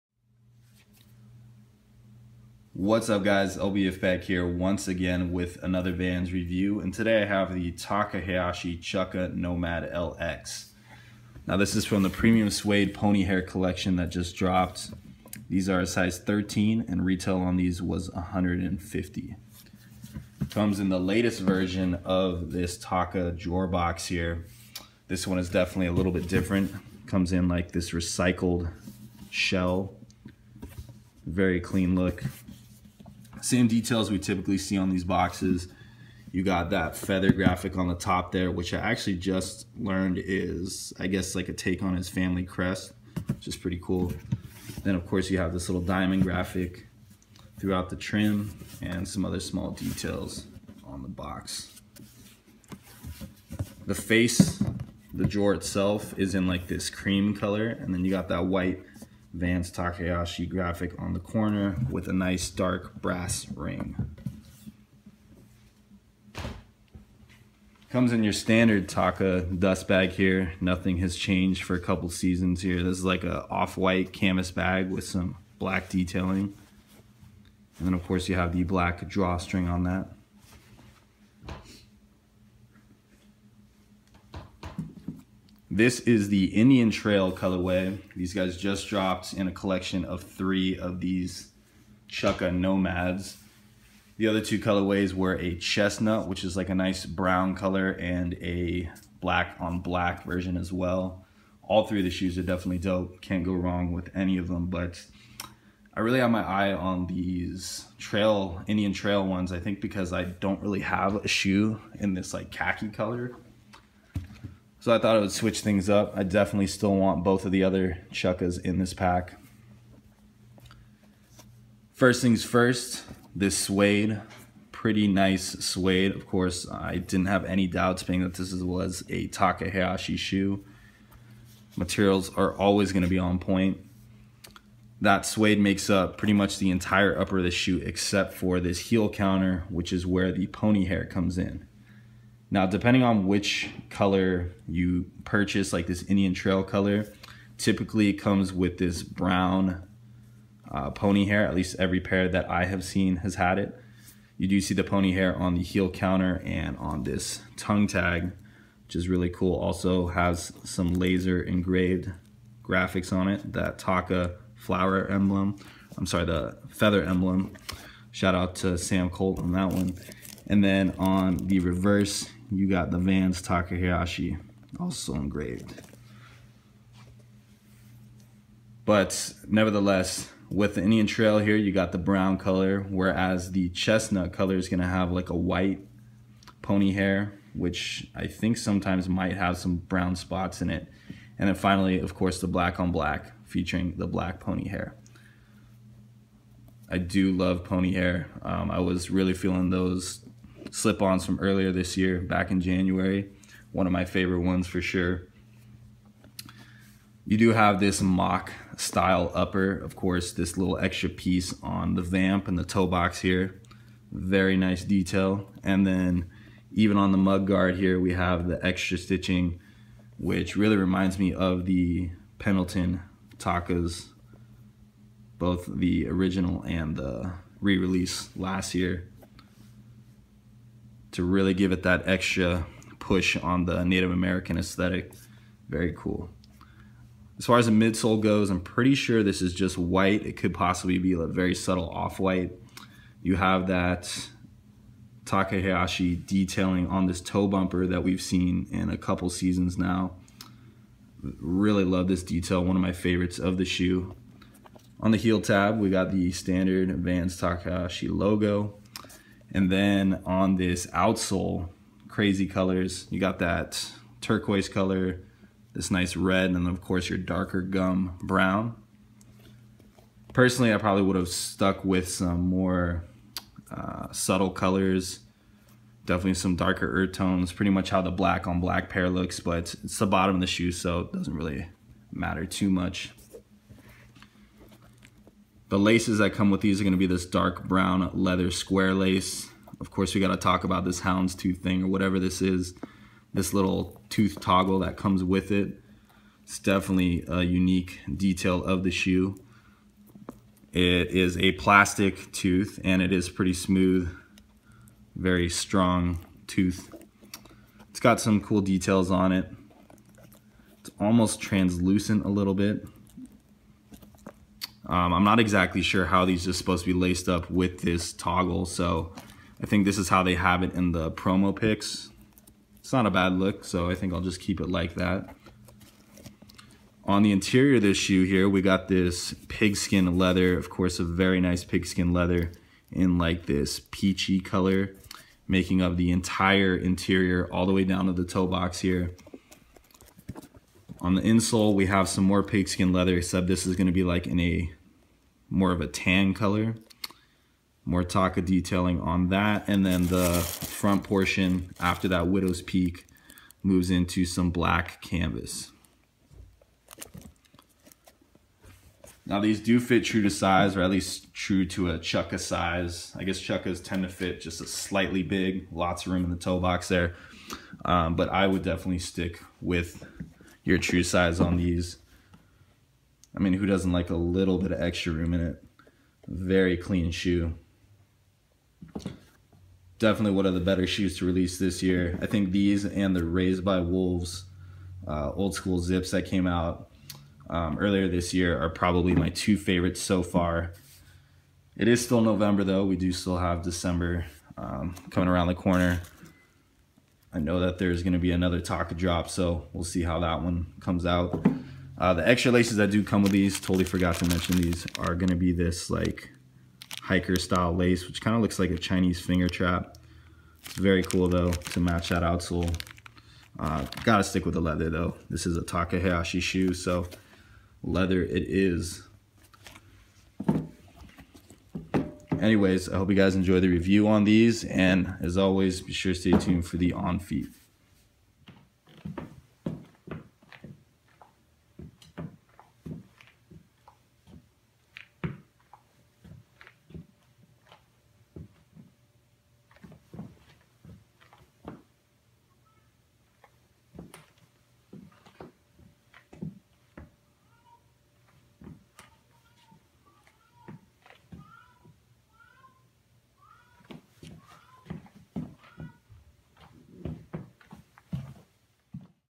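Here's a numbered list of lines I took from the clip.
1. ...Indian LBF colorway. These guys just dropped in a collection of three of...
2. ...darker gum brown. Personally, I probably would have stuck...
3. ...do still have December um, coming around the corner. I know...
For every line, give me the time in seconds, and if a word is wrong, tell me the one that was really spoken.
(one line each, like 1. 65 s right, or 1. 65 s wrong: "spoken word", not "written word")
1. 86 s wrong: "Trail", not "LBF"
2. 267 s right
3. 392 s right.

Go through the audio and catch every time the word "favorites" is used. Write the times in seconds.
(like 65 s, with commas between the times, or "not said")
204 s, 252 s, 389 s.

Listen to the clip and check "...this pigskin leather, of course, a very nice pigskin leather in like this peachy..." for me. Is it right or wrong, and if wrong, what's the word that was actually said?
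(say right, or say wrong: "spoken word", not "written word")
right.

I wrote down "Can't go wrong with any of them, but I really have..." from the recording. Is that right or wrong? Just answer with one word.
right.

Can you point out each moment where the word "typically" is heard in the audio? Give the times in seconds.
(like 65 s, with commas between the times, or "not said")
34 s, 147 s.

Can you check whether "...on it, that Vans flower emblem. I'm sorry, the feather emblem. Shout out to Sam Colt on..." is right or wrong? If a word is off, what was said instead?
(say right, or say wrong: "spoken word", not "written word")
wrong: "Taka", not "Vans".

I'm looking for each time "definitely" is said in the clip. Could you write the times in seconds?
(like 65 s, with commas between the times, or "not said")
25 s, 102 s, 116 s, 276 s, 296 s, 368 s, 379 s.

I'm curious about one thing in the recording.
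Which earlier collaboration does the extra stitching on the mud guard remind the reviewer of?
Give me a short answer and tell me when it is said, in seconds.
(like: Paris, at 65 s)
Pendleton Takas, at 222 s.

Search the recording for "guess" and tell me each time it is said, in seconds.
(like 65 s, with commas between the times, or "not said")
41 s, 363 s.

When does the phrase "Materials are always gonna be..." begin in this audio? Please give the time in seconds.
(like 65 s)
131 s.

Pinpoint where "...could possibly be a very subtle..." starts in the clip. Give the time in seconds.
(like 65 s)
240 s.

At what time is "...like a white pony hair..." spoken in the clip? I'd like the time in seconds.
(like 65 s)
185 s.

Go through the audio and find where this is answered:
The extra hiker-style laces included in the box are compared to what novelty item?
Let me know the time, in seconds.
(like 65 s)
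408 s.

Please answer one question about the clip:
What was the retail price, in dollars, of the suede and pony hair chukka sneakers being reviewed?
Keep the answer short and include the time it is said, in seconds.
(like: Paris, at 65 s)
150, at 18 s.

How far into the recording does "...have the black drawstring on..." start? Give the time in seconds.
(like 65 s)
78 s.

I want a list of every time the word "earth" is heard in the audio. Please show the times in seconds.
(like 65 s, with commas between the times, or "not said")
276 s.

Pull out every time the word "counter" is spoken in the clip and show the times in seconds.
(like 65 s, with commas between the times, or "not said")
139 s, 155 s.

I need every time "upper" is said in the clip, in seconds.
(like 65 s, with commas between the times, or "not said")
137 s, 209 s.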